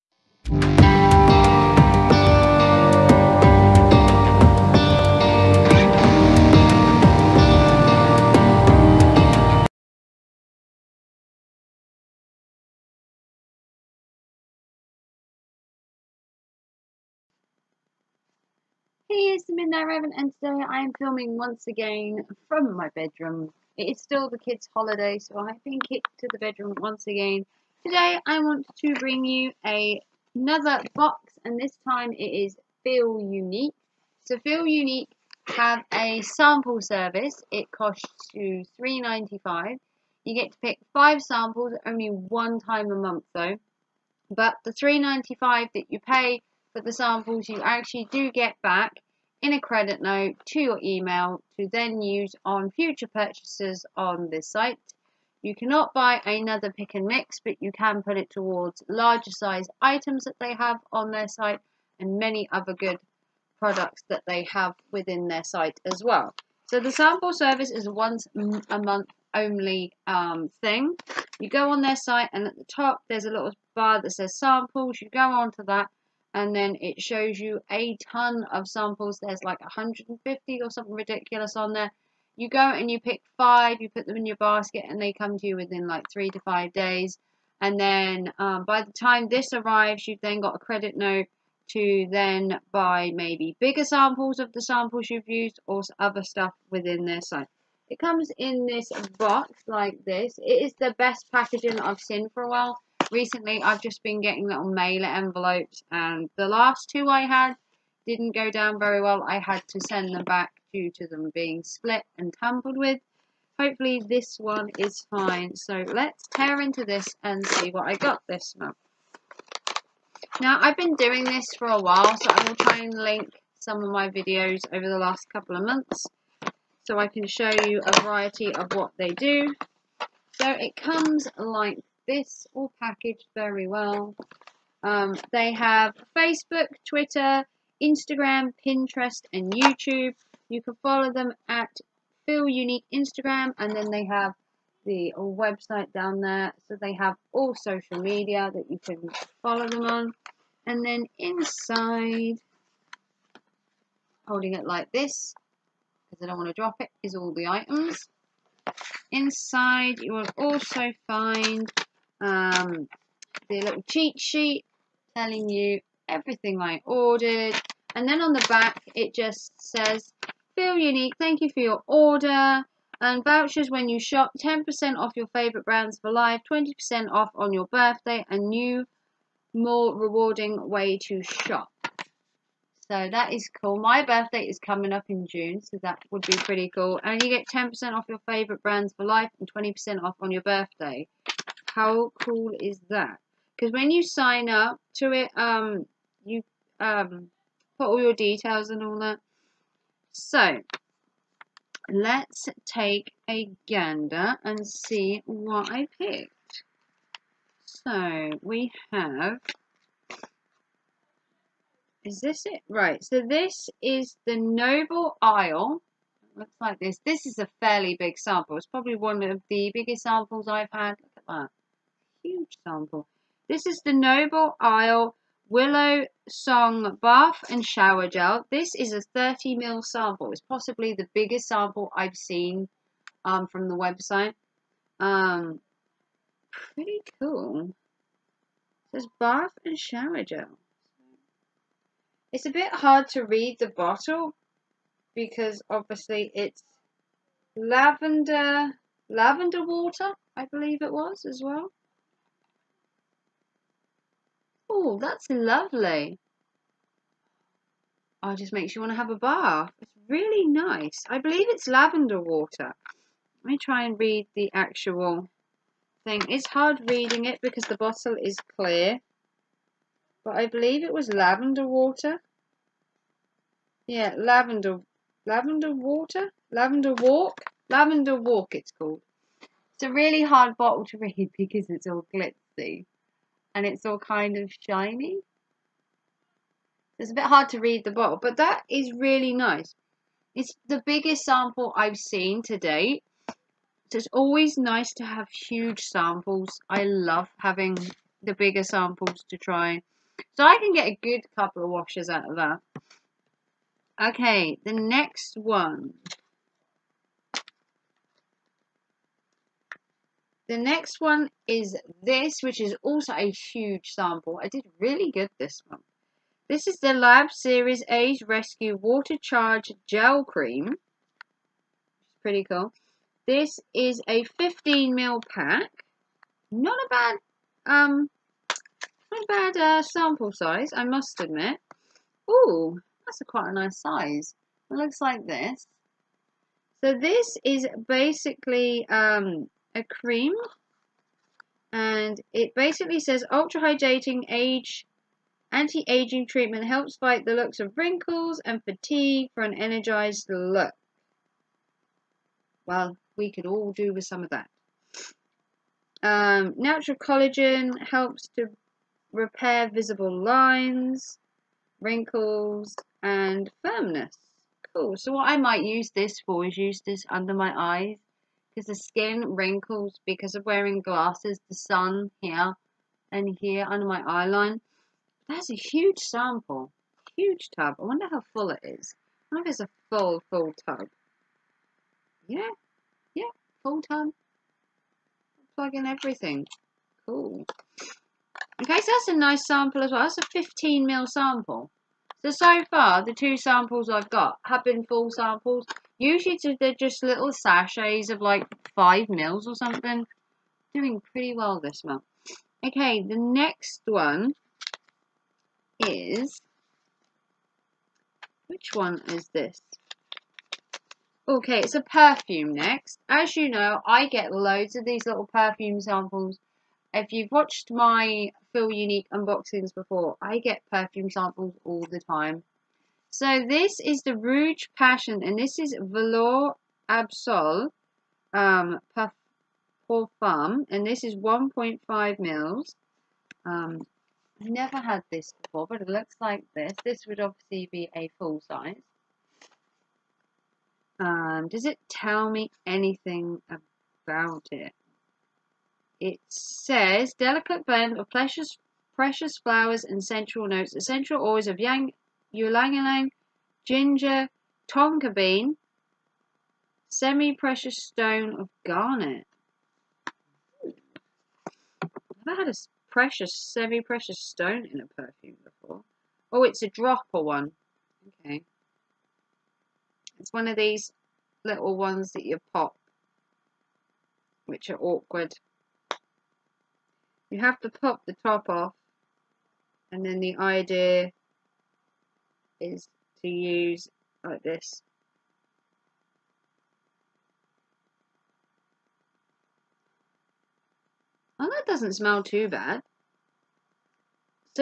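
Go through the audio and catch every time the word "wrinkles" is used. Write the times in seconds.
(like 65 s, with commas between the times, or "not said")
347 s, 361 s, 369 s.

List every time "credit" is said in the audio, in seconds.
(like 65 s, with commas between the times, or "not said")
49 s, 90 s.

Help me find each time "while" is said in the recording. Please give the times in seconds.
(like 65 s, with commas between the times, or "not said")
102 s, 121 s.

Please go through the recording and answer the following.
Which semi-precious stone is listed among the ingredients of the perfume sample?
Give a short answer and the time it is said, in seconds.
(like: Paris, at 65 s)
garnet, at 458 s.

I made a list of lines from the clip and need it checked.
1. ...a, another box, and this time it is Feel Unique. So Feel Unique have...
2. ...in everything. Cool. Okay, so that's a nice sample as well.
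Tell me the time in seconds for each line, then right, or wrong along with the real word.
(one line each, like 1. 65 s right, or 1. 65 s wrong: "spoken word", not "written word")
1. 29 s right
2. 385 s right.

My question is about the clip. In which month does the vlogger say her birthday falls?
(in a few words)
June.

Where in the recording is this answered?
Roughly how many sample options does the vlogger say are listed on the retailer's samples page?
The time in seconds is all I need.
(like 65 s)
79 s.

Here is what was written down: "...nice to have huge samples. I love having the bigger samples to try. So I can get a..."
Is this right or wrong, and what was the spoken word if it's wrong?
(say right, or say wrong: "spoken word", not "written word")
right.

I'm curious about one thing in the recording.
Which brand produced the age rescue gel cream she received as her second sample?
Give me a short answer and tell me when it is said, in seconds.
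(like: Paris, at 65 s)
Lab Series, at 316 s.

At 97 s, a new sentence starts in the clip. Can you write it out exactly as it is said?
It comes in this box like this.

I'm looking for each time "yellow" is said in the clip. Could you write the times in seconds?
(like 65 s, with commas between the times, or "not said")
not said.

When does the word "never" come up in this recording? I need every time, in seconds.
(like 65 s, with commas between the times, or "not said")
434 s, 462 s.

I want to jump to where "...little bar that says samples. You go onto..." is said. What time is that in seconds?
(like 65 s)
73 s.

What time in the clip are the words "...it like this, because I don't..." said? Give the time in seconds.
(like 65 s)
154 s.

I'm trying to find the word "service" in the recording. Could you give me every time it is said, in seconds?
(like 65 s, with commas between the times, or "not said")
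36 s, 67 s.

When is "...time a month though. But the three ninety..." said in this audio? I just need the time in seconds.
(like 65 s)
42 s.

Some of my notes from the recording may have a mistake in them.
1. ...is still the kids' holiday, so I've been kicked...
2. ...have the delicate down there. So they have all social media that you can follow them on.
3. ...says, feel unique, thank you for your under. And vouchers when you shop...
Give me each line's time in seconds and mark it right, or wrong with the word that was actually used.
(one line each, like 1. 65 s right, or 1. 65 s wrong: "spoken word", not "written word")
1. 23 s right
2. 144 s wrong: "website", not "delicate"
3. 169 s wrong: "order", not "under".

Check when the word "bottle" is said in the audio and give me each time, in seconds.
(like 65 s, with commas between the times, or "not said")
243 s, 267 s, 280 s, 287 s.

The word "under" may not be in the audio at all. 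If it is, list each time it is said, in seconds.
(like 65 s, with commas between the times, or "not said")
367 s, 373 s.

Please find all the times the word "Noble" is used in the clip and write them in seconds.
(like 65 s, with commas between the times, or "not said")
214 s, 223 s.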